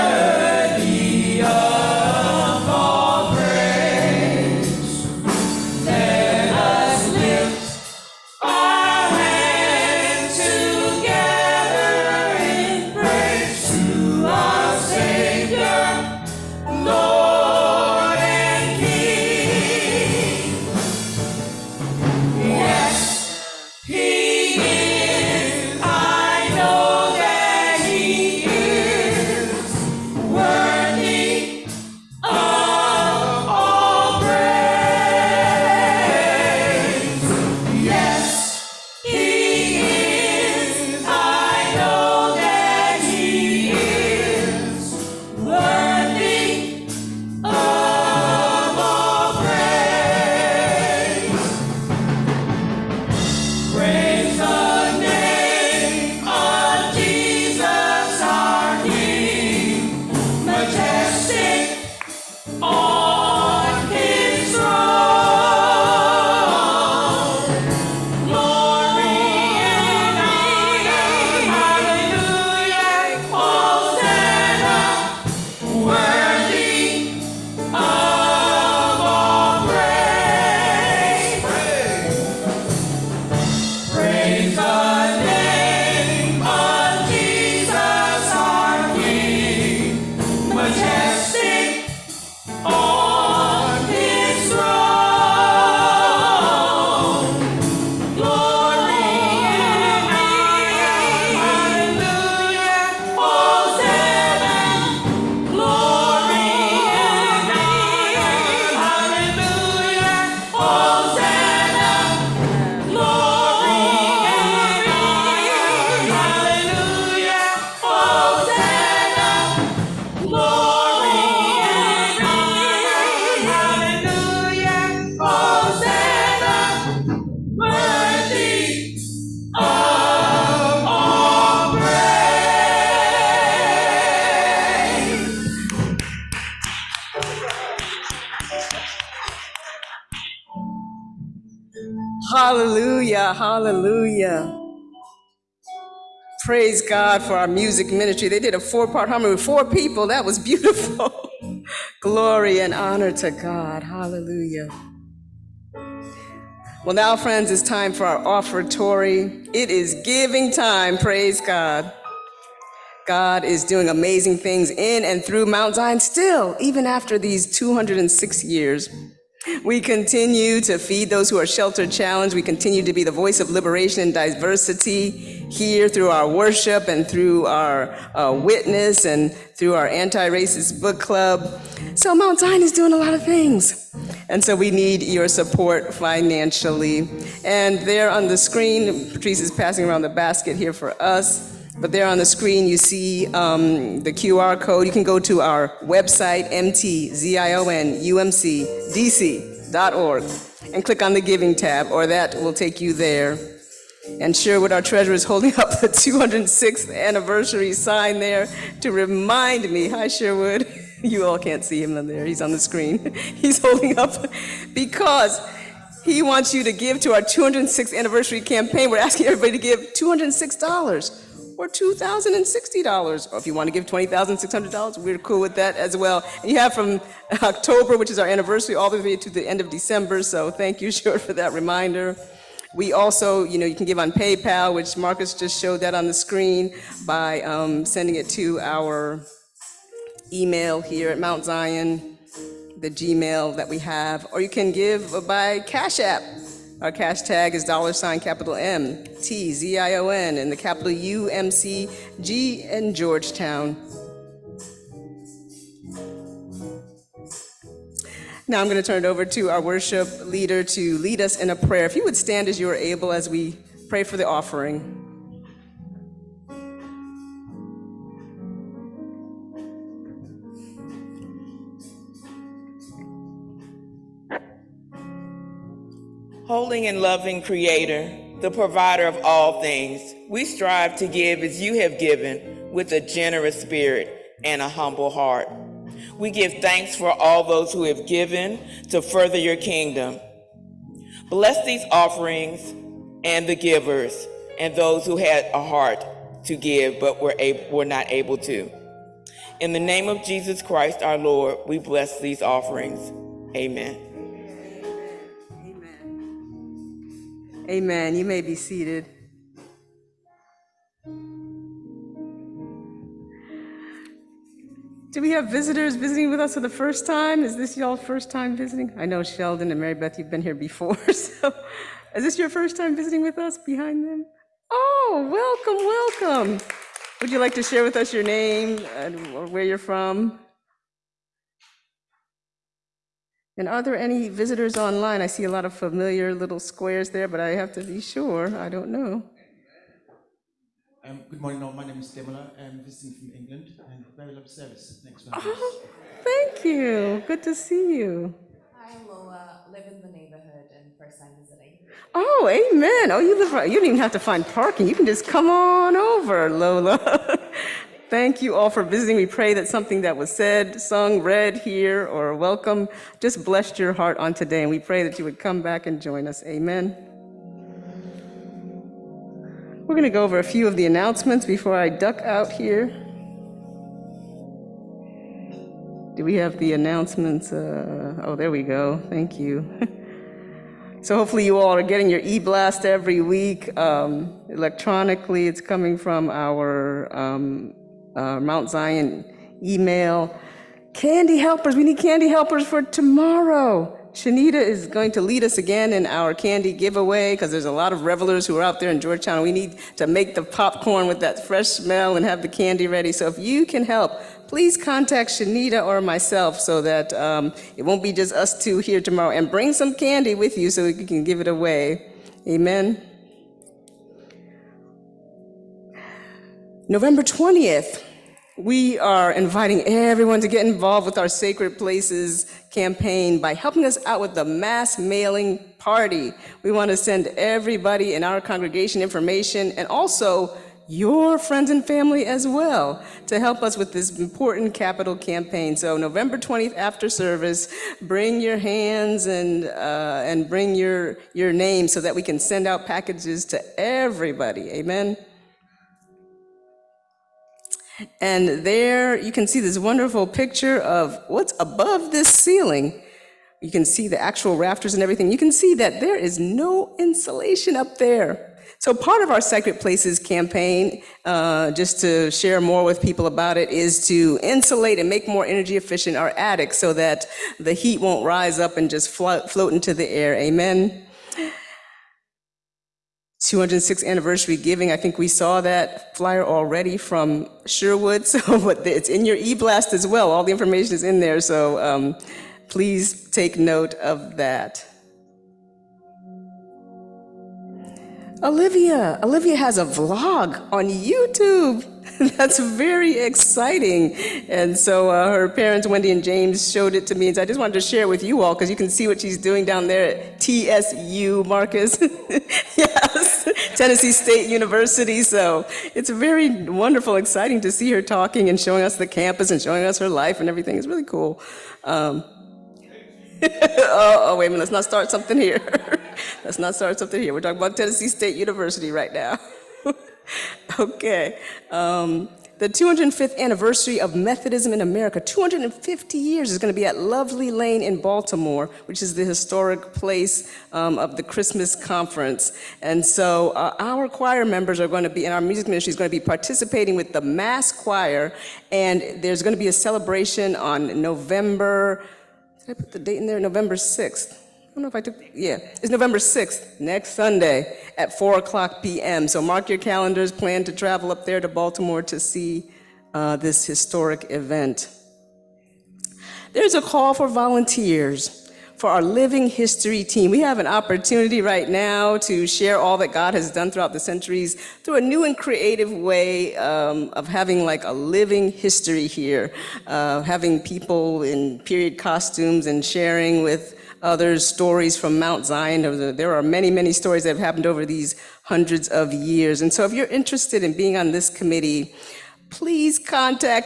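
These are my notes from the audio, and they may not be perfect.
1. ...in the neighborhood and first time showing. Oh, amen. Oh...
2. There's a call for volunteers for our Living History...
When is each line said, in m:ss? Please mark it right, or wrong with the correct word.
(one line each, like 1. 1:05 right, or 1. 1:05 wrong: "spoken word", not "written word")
1. 5:49 wrong: "visiting", not "showing"
2. 9:16 right.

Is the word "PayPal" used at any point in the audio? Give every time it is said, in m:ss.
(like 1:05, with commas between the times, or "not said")
3:54.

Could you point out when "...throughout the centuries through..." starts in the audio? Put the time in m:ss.
9:23.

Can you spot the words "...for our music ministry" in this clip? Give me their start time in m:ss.
2:27.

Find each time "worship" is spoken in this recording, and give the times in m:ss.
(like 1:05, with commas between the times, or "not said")
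2:56, 4:19.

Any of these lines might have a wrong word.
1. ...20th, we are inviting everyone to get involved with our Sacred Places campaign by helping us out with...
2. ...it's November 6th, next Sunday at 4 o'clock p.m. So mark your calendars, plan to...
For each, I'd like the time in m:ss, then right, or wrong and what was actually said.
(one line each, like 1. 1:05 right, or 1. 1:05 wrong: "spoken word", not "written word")
1. 6:57 right
2. 9:05 right.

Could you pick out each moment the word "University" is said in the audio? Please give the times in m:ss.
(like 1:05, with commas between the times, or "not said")
8:24, 8:38.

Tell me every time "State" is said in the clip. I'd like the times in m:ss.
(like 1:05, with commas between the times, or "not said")
8:24, 8:38.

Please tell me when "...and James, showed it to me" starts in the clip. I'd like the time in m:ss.
8:16.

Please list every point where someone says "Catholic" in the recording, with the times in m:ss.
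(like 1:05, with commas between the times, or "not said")
not said.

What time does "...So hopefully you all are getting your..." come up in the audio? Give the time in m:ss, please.
6:21.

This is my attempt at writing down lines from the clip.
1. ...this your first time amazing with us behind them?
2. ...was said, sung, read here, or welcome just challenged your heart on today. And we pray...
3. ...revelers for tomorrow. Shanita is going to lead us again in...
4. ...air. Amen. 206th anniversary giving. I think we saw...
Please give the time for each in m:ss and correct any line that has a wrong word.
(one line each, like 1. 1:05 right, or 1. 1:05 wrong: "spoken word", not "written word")
1. 5:22 wrong: "visiting", not "amazing"
2. 6:00 wrong: "blessed", not "challenged"
3. 6:32 wrong: "helpers", not "revelers"
4. 7:50 right.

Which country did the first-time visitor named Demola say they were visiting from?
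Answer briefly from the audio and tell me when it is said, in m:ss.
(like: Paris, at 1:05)
England, at 5:43.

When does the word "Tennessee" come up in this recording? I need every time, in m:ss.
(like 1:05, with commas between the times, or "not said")
8:23, 8:37.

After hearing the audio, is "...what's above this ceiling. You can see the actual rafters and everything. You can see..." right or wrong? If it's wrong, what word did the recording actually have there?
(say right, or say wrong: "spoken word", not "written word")
right.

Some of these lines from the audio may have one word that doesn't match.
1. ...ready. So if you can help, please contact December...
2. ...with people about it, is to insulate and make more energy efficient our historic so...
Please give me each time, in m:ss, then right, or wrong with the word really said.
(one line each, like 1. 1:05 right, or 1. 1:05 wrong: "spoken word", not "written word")
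1. 6:42 wrong: "Shanita", not "December"
2. 7:42 wrong: "attic", not "historic".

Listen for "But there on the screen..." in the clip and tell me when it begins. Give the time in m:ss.
3:11.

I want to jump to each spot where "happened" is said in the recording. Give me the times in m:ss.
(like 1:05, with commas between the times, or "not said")
9:37.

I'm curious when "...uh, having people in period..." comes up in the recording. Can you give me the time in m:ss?
9:29.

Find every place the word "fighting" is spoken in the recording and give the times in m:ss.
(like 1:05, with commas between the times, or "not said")
not said.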